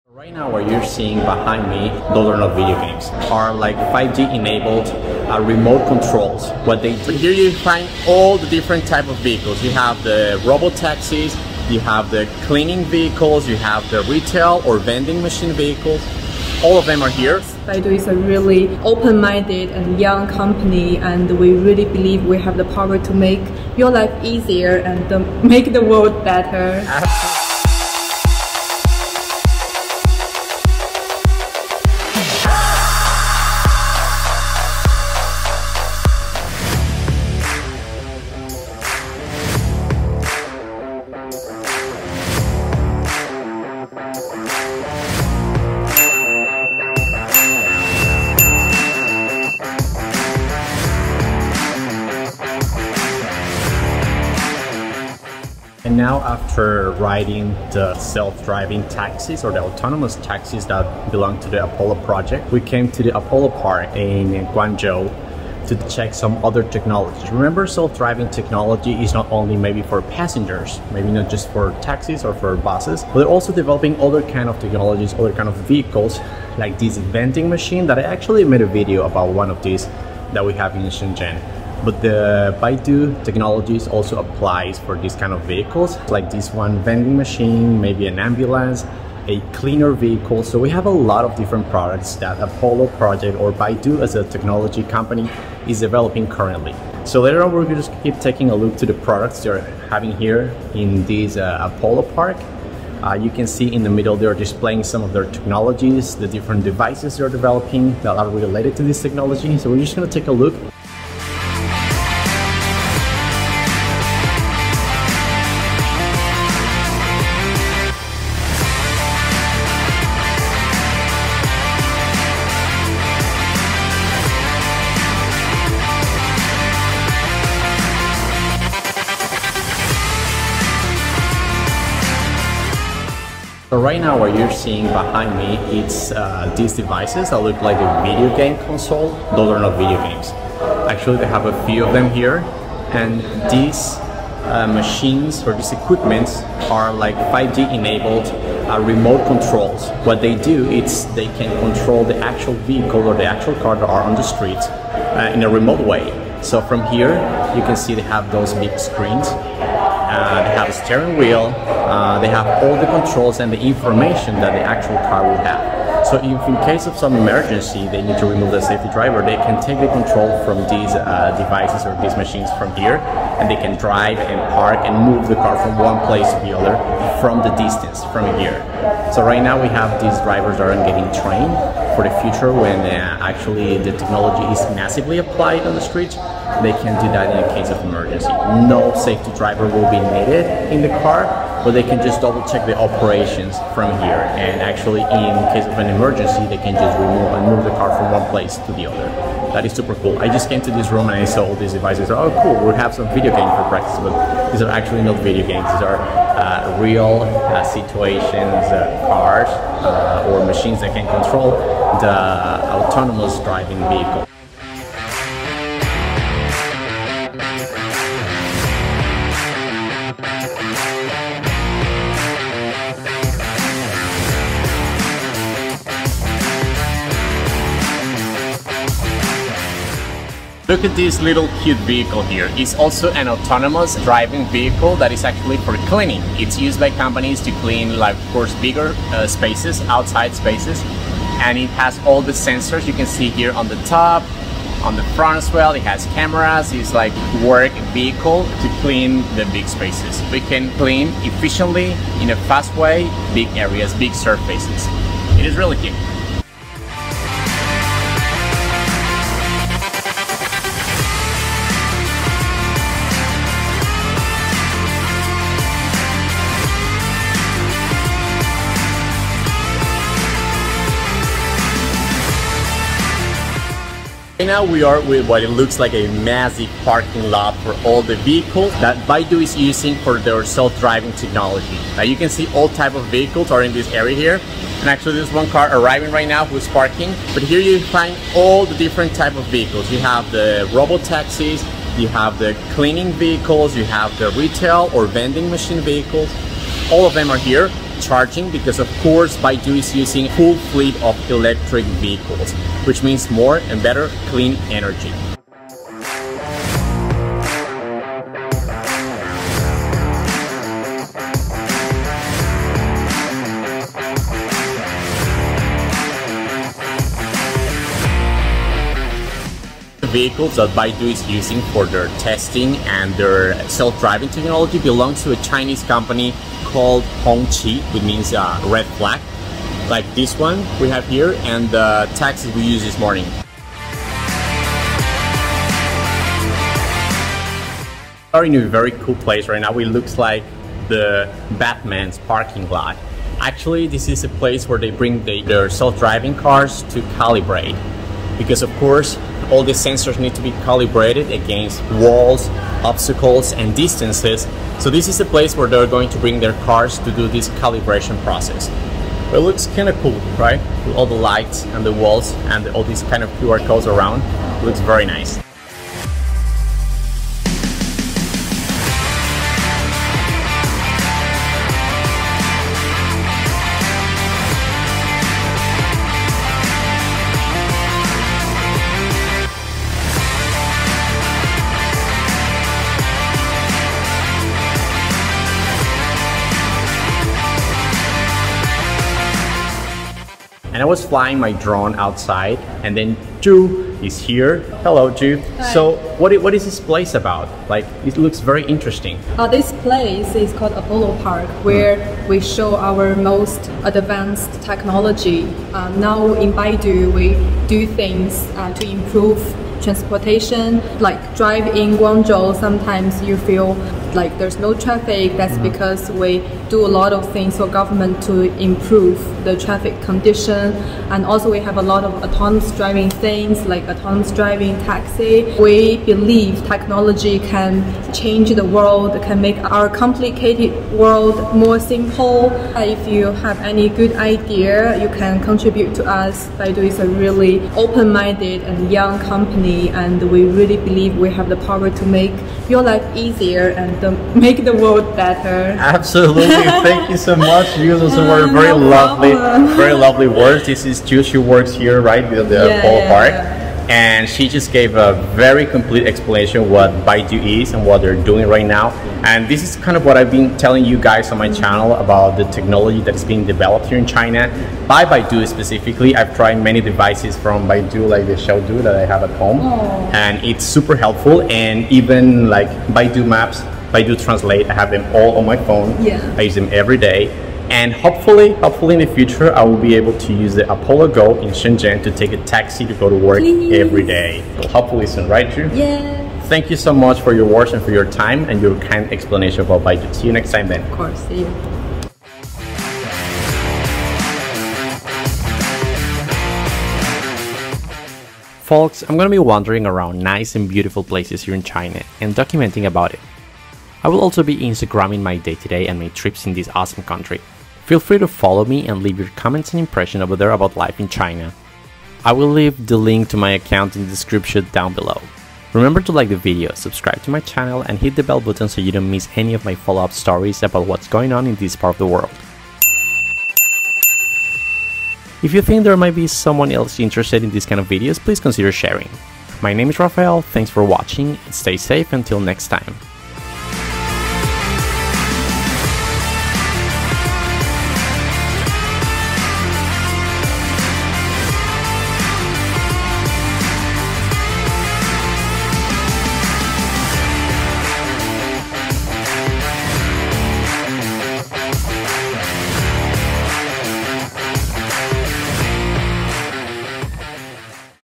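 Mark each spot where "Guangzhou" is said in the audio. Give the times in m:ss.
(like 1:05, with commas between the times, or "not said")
1:04, 6:51.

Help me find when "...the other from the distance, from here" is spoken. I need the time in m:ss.
2:56.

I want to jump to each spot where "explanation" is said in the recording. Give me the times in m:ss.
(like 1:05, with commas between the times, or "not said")
7:36, 8:09.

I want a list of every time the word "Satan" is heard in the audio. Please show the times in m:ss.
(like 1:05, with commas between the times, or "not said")
not said.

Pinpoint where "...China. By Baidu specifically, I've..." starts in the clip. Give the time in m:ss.
7:44.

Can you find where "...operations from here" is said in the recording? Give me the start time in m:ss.
3:12.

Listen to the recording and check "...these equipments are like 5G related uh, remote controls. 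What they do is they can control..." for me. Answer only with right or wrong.
wrong.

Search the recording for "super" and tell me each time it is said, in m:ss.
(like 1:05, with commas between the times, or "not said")
3:19, 7:50.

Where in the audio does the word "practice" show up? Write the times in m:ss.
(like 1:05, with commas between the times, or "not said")
3:23.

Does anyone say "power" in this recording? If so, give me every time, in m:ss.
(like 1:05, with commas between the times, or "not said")
0:22, 7:21.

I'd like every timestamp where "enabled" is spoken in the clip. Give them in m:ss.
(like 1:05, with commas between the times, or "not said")
0:04, 2:27.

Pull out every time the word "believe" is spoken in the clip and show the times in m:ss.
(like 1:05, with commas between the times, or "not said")
0:21, 7:05, 7:20.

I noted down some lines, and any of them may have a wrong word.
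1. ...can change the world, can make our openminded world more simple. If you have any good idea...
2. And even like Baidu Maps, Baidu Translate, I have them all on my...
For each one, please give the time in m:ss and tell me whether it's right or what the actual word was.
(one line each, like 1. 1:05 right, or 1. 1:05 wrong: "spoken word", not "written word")
1. 7:07 wrong: "complicated", not "openminded"
2. 7:51 right.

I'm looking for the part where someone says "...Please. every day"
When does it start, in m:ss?
8:03.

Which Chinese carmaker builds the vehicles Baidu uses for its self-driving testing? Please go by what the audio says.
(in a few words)
Hongqi.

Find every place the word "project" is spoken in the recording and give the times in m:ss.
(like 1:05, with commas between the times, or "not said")
1:02, 1:32.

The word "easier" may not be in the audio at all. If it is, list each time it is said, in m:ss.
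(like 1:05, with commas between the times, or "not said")
0:24, 7:23.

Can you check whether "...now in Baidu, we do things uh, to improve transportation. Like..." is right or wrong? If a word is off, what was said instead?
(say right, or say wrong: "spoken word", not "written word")
right.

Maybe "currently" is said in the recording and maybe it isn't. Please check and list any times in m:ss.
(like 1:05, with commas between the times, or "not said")
1:36.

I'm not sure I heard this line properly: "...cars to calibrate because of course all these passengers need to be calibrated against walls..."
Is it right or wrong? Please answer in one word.
wrong.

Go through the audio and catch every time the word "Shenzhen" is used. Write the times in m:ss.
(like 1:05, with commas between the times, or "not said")
1:20, 8:01.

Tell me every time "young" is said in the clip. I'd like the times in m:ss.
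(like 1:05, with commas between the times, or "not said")
0:19, 7:18.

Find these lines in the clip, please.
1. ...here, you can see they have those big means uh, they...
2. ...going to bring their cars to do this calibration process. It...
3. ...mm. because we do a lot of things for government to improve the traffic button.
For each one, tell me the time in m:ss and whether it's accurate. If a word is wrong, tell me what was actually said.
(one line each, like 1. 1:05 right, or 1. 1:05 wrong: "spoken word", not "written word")
1. 2:36 wrong: "screens", not "means"
2. 5:55 right
3. 6:55 wrong: "condition", not "button".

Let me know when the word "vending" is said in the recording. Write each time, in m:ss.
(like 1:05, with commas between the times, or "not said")
0:14, 1:16, 1:26, 4:55.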